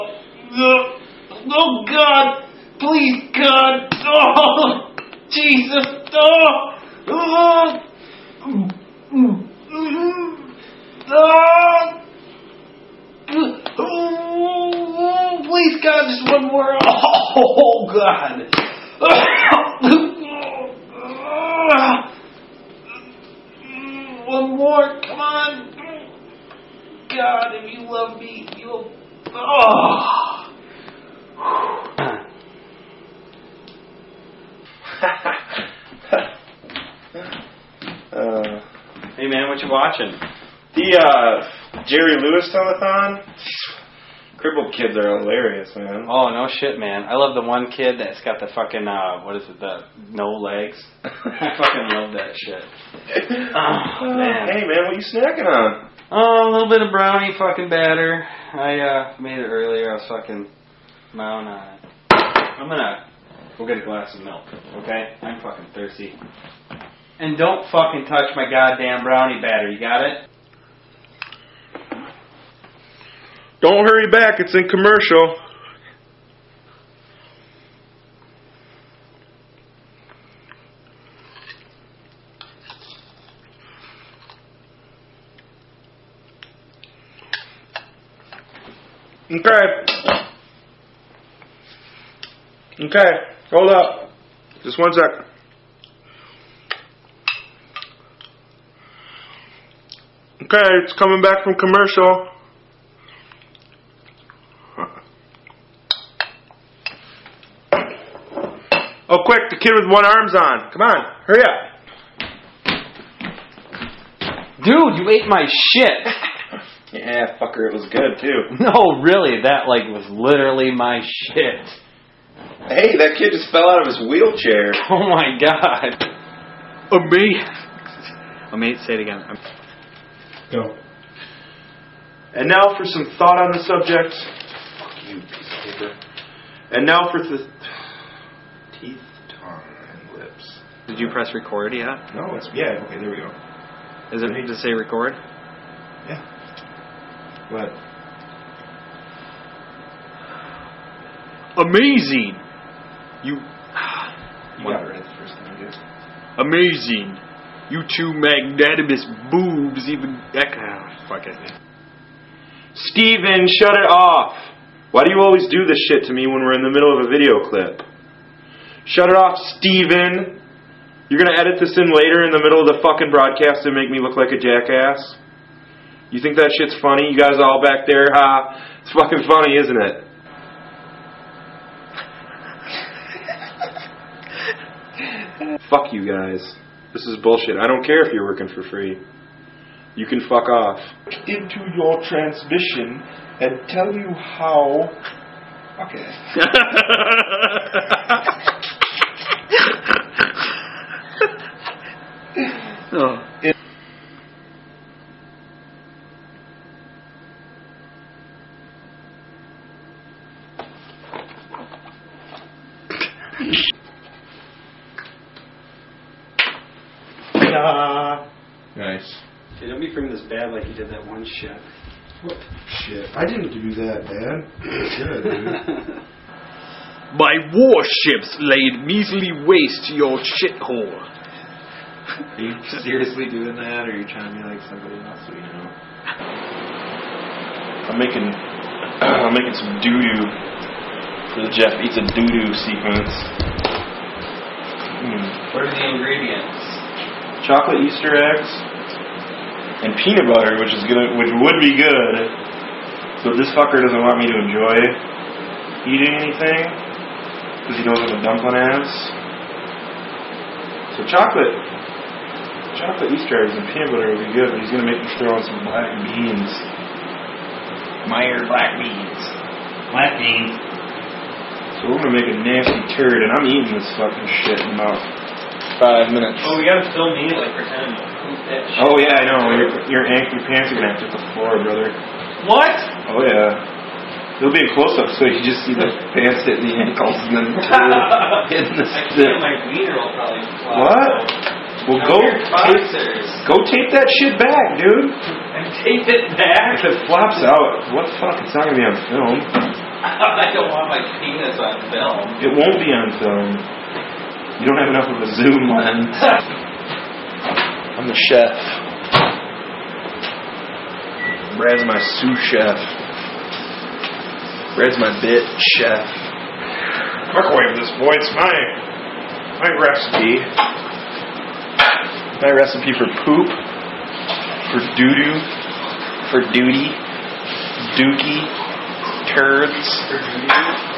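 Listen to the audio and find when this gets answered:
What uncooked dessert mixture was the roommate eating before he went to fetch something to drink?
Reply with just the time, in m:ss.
0:56.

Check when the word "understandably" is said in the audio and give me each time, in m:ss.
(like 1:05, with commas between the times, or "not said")
not said.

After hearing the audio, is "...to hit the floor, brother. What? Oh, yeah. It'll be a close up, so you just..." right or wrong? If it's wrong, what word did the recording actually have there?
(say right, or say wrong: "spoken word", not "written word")
right.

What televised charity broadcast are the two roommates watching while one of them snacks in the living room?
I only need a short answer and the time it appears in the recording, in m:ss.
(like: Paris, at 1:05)
Jerry Lewis telethon, at 0:41.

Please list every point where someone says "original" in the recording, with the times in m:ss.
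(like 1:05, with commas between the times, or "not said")
not said.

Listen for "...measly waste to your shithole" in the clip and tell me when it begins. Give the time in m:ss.
3:48.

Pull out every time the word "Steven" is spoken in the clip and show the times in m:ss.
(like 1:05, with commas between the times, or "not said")
2:42, 2:49.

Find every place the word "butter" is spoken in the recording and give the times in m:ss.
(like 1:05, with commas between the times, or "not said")
4:10, 4:23.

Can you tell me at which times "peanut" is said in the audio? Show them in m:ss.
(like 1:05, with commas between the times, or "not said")
4:10, 4:23.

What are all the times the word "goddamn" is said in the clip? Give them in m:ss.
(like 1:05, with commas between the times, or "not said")
1:08.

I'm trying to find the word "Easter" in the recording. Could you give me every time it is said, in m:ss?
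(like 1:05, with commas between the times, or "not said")
4:07, 4:23.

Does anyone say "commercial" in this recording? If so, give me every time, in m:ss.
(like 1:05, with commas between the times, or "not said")
1:14, 1:41.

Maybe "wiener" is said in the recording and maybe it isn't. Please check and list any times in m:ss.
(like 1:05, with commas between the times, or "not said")
4:49.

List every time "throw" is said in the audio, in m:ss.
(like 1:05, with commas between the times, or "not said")
4:25.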